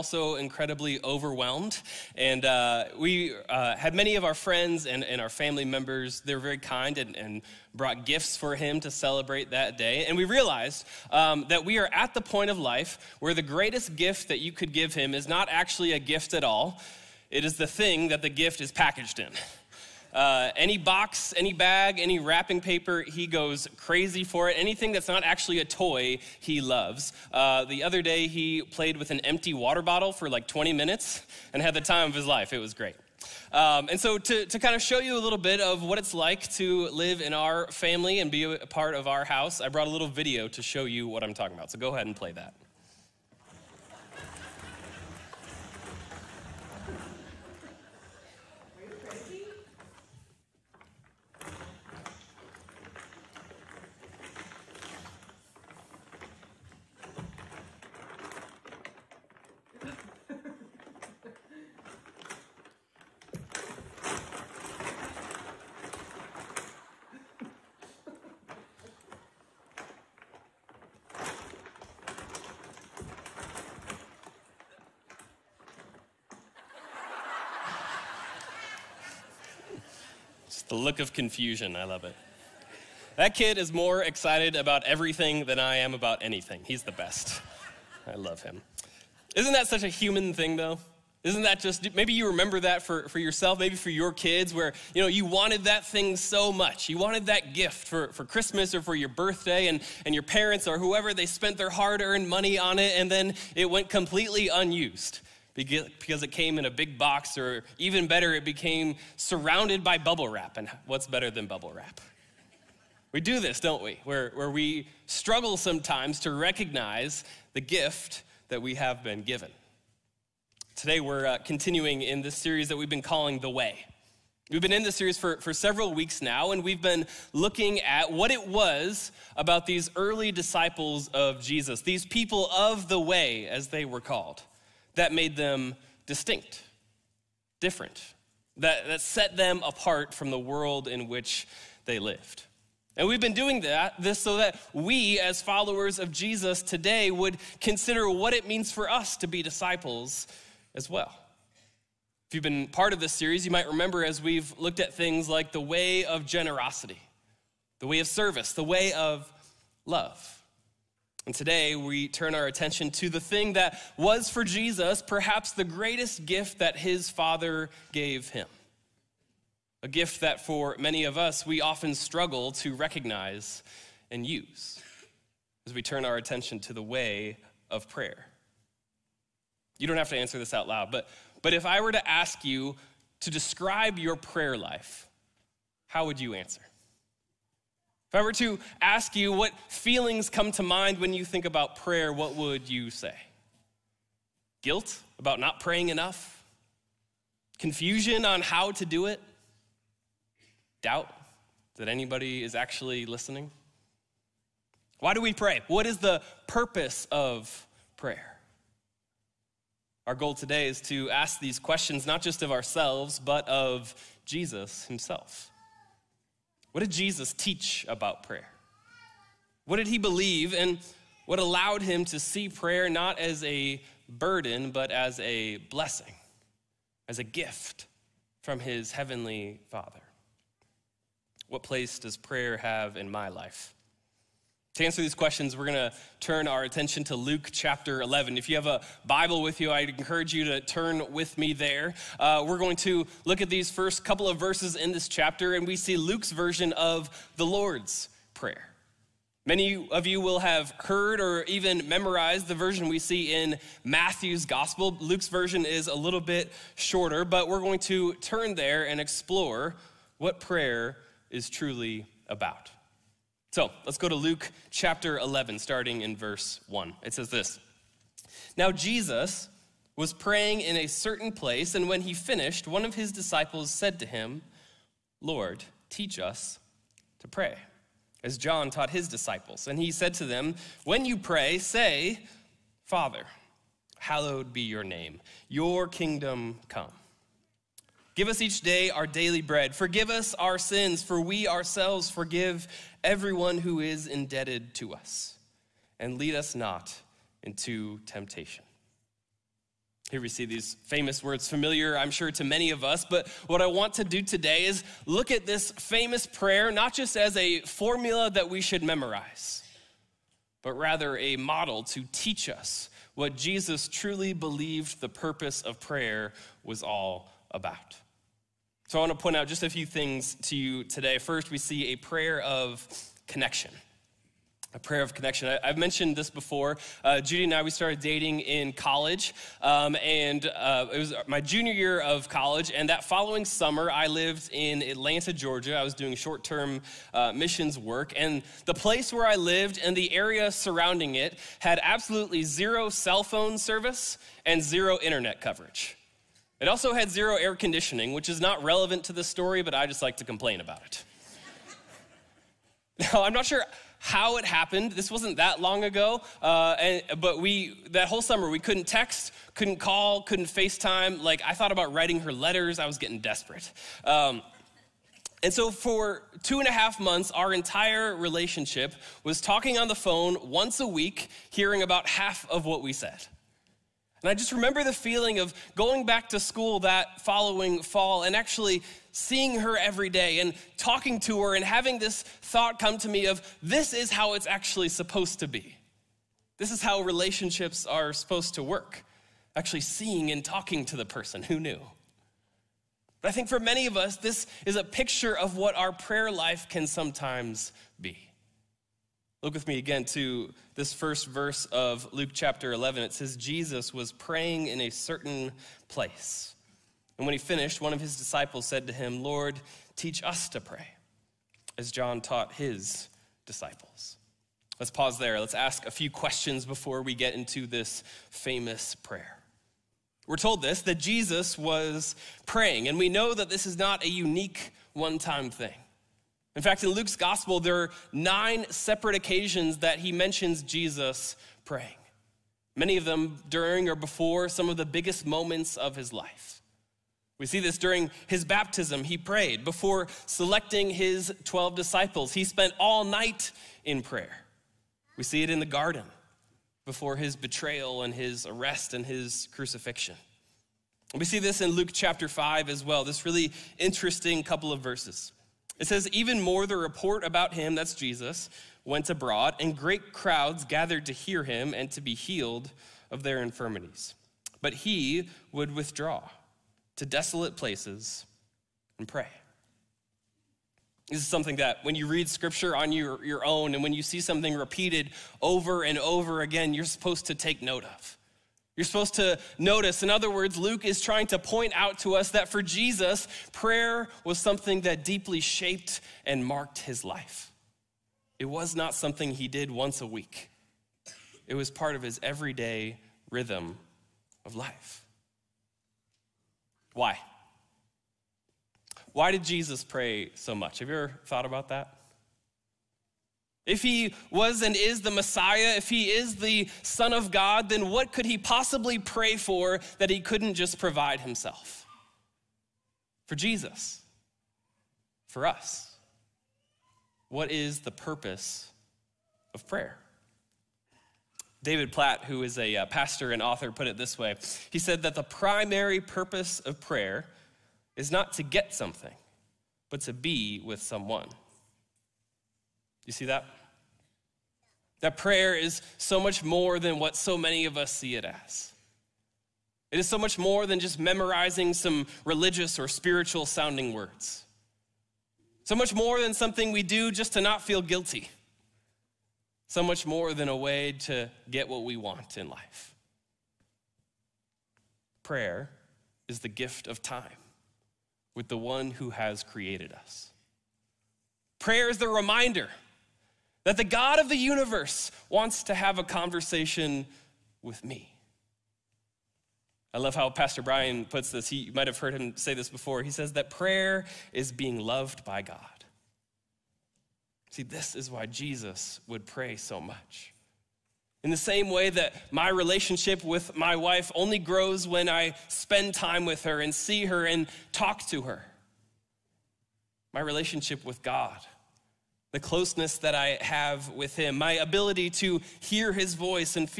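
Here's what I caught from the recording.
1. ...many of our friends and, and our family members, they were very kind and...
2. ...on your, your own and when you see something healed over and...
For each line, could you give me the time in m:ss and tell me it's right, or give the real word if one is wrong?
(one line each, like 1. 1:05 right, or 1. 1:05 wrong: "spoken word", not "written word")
1. 0:03 right
2. 7:52 wrong: "repeated", not "healed".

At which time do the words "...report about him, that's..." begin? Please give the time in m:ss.
7:36.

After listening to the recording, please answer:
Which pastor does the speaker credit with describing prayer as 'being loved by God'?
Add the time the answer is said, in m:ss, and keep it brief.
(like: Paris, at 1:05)
Pastor Brian, at 9:30.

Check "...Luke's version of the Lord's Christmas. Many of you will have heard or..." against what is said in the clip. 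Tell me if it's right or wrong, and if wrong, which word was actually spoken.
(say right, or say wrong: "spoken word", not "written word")
wrong: "Prayer", not "Christmas".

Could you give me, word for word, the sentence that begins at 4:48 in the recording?
Give us each day our daily bread.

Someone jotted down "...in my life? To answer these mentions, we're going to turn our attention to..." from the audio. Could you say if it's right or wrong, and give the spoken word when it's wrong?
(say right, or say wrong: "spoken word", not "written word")
wrong: "questions", not "mentions".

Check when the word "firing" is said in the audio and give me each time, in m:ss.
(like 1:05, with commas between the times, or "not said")
not said.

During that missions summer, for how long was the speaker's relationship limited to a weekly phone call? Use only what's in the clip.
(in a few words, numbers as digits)
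two and a half months.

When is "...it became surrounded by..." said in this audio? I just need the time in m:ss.
1:48.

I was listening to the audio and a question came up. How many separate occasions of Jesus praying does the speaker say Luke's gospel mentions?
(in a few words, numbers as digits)
9.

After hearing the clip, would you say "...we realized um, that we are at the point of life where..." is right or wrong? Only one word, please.
right.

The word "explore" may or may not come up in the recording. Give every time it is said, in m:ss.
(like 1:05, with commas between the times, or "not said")
4:18.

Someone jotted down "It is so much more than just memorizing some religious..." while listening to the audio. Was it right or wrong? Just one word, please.
right.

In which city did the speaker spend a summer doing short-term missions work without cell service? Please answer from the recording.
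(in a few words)
Atlanta, Georgia.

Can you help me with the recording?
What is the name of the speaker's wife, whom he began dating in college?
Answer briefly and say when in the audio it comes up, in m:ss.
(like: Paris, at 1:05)
Judy, at 5:27.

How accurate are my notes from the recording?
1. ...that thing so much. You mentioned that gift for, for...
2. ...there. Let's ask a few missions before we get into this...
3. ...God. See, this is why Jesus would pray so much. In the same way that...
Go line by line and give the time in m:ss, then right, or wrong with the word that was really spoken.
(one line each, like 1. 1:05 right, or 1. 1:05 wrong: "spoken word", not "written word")
1. 1:35 wrong: "wanted", not "mentioned"
2. 6:55 wrong: "questions", not "missions"
3. 9:35 right.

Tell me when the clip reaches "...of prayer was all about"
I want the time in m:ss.
5:15.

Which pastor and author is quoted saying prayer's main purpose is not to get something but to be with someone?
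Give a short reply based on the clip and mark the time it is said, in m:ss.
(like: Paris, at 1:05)
David Platt, at 8:41.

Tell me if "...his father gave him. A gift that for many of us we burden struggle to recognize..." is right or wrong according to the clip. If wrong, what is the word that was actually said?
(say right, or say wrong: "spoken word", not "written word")
wrong: "often", not "burden".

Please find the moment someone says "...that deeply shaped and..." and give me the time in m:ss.
8:04.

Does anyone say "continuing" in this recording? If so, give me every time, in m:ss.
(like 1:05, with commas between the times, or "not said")
2:01.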